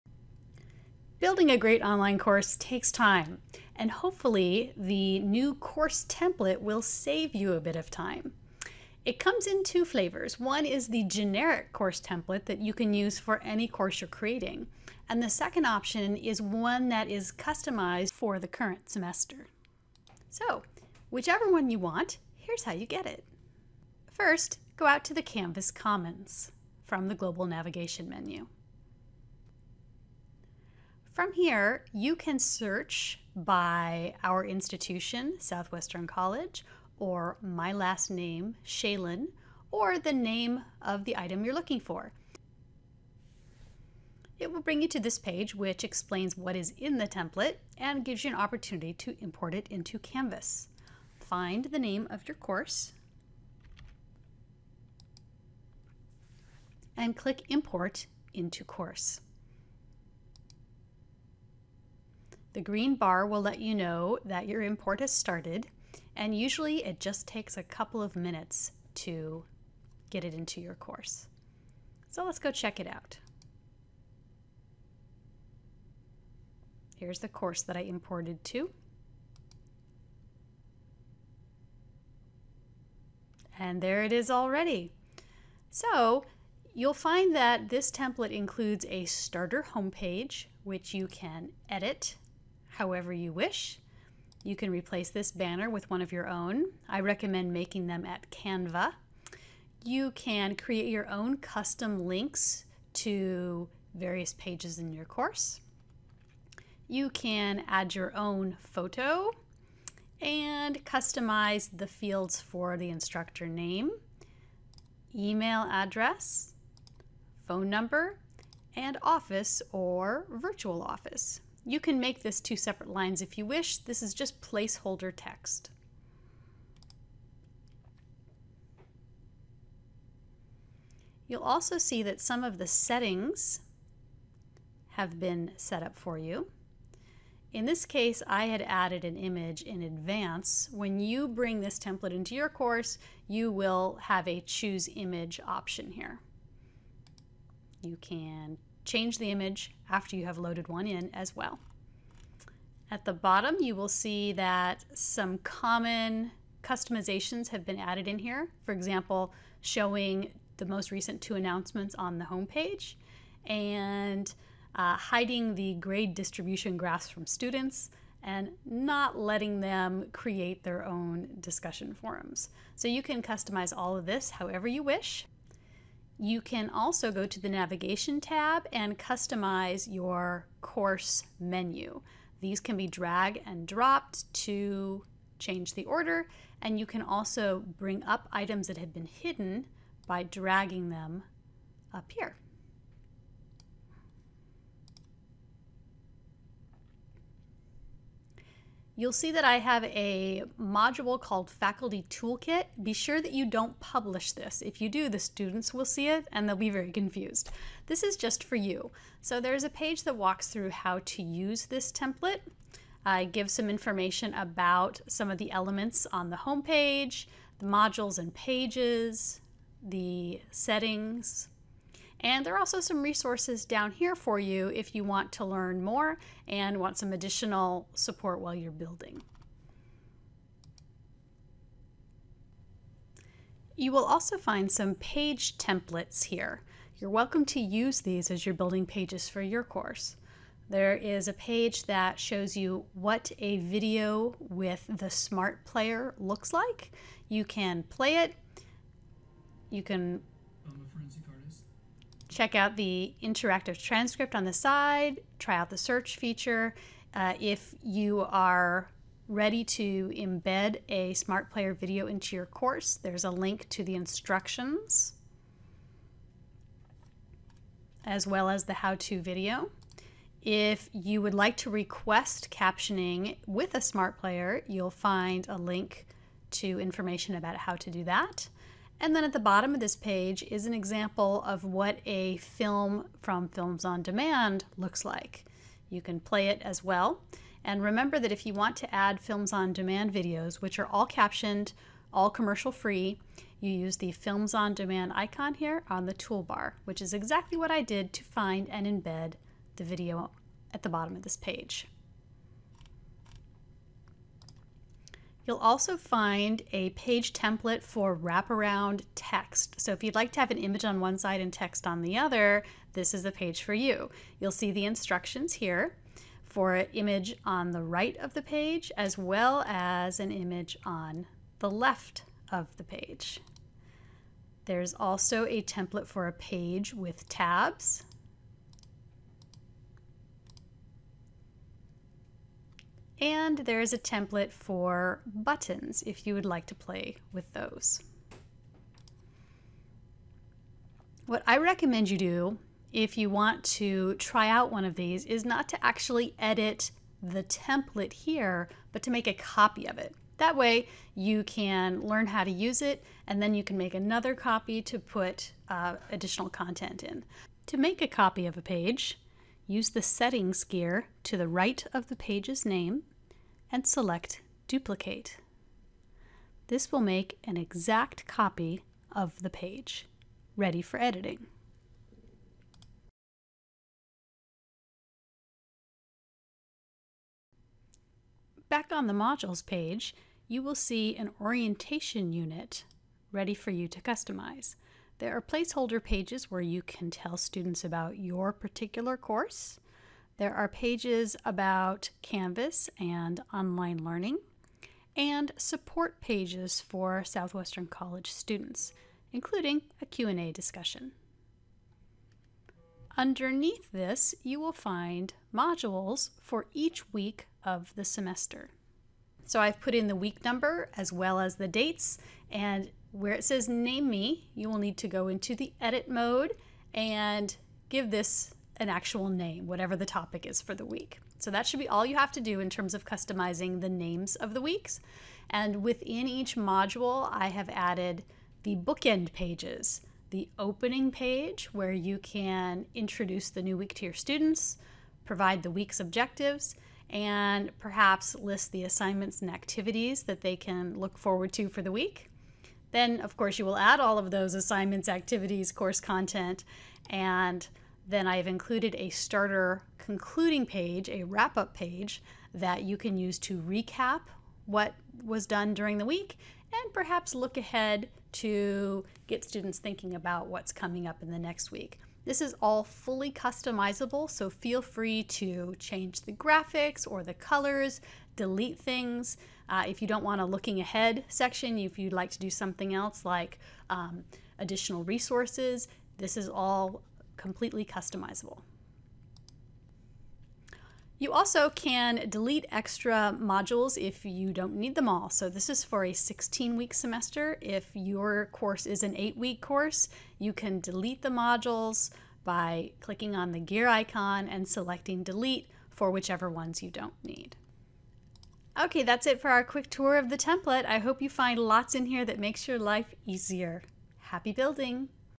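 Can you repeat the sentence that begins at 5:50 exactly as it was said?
That way you can learn how to use it and then you can make another copy to put uh, additional content in.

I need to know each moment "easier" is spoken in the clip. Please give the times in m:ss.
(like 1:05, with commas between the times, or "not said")
8:23.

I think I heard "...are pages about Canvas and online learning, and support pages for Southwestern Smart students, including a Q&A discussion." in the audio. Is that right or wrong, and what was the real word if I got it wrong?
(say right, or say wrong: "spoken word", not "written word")
wrong: "College", not "Smart".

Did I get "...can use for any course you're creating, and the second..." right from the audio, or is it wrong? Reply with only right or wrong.
right.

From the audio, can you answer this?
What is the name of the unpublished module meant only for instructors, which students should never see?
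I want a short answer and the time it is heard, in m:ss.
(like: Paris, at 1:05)
Faculty Toolkit, at 3:21.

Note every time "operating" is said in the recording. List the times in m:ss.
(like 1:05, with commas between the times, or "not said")
not said.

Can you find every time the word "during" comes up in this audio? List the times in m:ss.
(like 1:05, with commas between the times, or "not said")
7:35.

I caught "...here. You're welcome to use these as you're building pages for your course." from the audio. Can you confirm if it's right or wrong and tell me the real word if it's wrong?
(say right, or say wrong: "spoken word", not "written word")
right.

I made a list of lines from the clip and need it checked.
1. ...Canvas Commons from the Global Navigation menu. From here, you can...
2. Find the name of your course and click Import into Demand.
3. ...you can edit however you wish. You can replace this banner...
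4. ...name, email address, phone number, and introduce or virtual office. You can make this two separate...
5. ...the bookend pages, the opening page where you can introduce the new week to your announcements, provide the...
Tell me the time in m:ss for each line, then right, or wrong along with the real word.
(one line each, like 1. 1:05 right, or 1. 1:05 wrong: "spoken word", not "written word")
1. 0:25 right
2. 0:51 wrong: "Course", not "Demand"
3. 1:30 right
4. 1:53 wrong: "office", not "introduce"
5. 7:08 wrong: "students", not "announcements".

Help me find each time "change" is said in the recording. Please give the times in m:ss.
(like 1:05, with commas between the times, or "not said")
2:28, 3:05, 7:45.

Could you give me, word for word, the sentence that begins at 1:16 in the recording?
Here's the course that I imported to.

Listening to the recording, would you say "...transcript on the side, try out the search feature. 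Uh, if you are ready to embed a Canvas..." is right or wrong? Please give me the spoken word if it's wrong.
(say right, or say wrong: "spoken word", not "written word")
wrong: "Smart", not "Canvas".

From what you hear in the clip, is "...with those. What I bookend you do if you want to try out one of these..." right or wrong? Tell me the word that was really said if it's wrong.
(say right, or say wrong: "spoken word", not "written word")
wrong: "recommend", not "bookend".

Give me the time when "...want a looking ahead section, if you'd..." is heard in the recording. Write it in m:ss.
7:50.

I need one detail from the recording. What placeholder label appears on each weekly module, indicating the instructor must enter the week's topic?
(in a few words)
Name Me.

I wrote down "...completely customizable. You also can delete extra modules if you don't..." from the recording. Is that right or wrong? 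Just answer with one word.
right.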